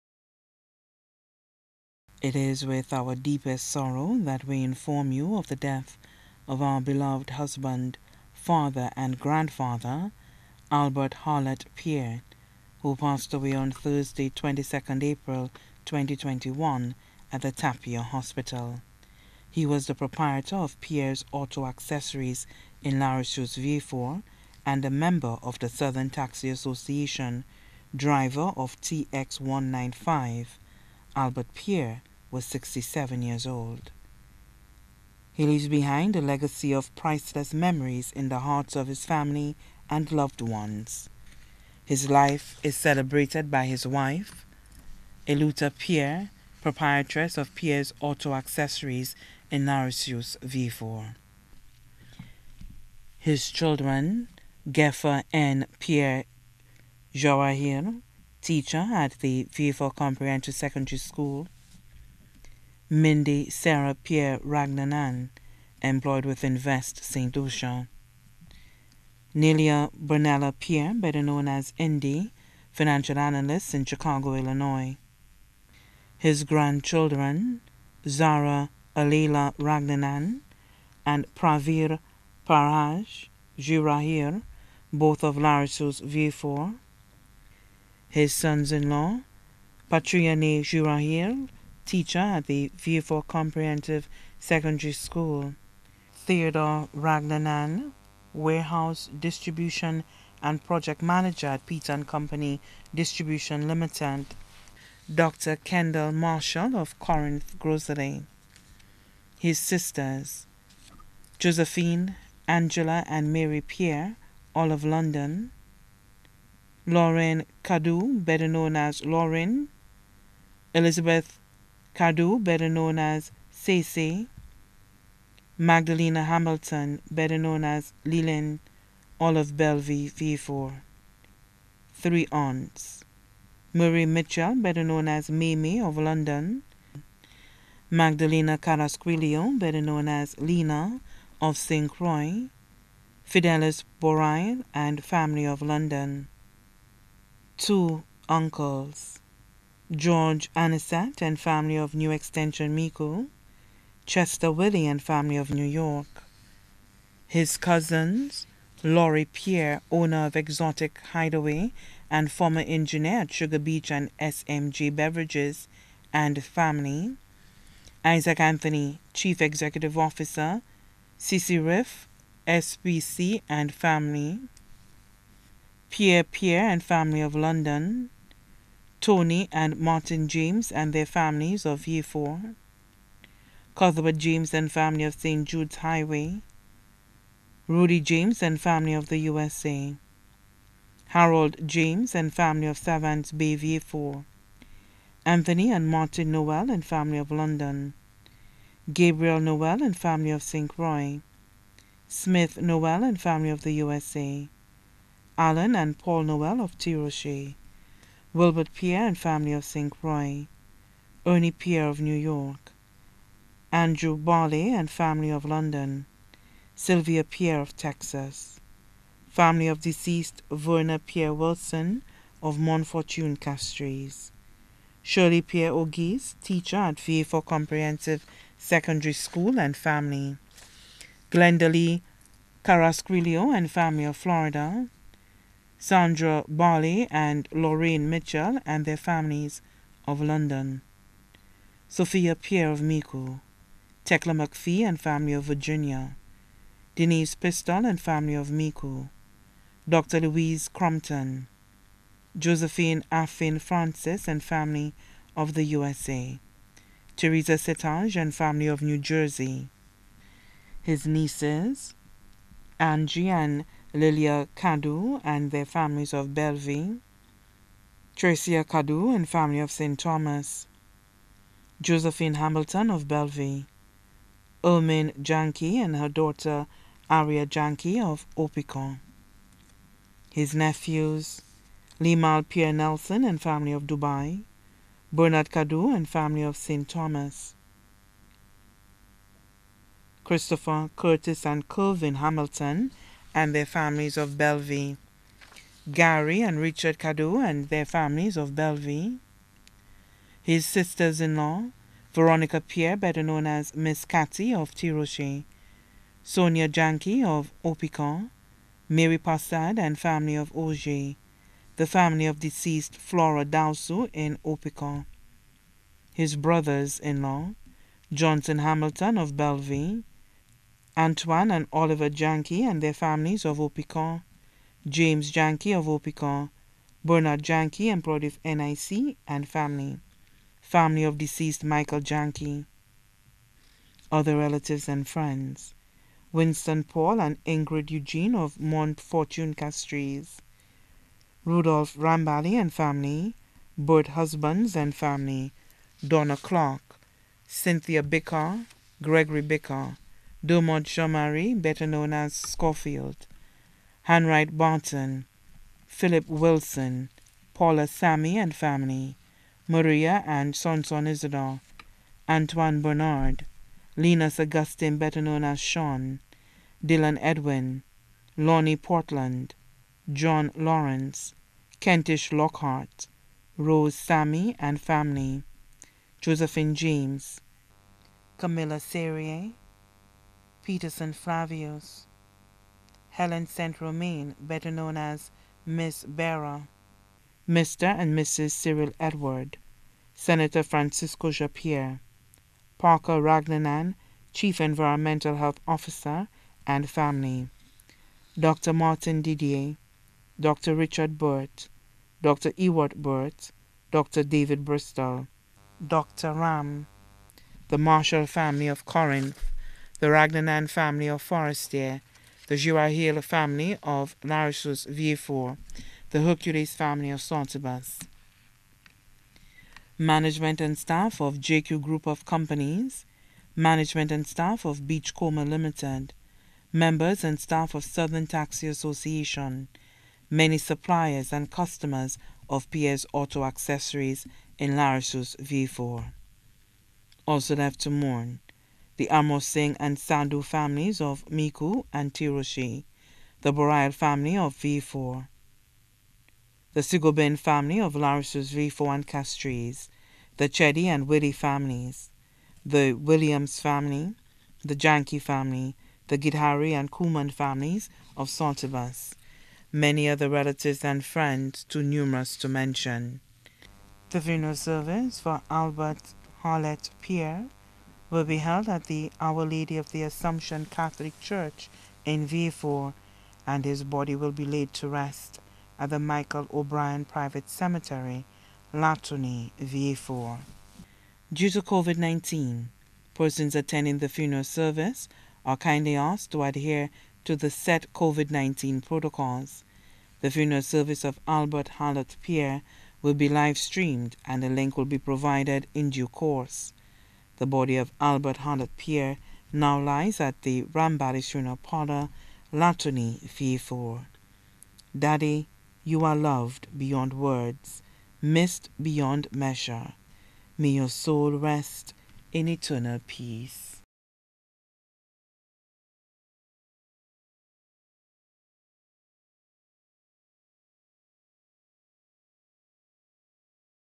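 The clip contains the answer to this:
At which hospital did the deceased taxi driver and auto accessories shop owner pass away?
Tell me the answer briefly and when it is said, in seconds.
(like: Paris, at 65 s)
Tapion Hospital, at 17 s.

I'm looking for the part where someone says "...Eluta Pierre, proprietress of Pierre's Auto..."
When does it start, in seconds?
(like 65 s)
45 s.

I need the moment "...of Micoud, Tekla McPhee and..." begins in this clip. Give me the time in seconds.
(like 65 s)
242 s.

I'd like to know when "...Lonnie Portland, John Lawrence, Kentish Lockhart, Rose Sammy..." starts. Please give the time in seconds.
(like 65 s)
368 s.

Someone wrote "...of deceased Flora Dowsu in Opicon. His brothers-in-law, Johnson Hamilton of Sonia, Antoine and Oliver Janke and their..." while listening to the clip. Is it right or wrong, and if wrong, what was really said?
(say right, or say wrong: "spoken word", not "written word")
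wrong: "Bellevue", not "Sonia".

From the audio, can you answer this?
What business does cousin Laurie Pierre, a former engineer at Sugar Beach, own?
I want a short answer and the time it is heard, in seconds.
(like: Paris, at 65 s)
Exotic Hideaway, at 160 s.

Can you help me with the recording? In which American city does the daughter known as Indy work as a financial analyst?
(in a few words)
Chicago.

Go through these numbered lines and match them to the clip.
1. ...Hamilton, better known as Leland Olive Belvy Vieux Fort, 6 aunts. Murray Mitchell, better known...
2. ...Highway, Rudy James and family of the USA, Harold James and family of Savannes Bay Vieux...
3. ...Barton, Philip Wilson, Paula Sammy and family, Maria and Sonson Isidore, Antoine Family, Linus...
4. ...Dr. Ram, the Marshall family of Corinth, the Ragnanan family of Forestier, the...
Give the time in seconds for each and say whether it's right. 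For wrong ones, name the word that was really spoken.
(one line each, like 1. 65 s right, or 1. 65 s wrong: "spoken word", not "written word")
1. 126 s wrong: "3", not "6"
2. 185 s right
3. 354 s wrong: "Bernard", not "Family"
4. 405 s right.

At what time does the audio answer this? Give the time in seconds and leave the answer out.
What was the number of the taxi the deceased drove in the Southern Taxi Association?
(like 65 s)
28 s.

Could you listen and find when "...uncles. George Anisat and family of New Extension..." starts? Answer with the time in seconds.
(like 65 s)
148 s.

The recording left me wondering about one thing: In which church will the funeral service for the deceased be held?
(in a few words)
Our Lady of the Assumption Catholic Church.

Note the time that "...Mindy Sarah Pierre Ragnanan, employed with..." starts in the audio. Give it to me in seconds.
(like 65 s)
62 s.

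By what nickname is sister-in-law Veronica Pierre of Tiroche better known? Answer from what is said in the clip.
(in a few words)
Miss Catty.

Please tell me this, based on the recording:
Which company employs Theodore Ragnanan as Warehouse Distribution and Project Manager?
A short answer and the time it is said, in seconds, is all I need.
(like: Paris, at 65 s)
Peter and Company Distribution Limited, at 101 s.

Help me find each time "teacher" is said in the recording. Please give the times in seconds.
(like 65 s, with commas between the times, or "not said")
58 s, 91 s, 226 s.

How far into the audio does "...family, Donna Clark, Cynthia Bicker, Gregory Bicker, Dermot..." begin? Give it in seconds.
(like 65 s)
344 s.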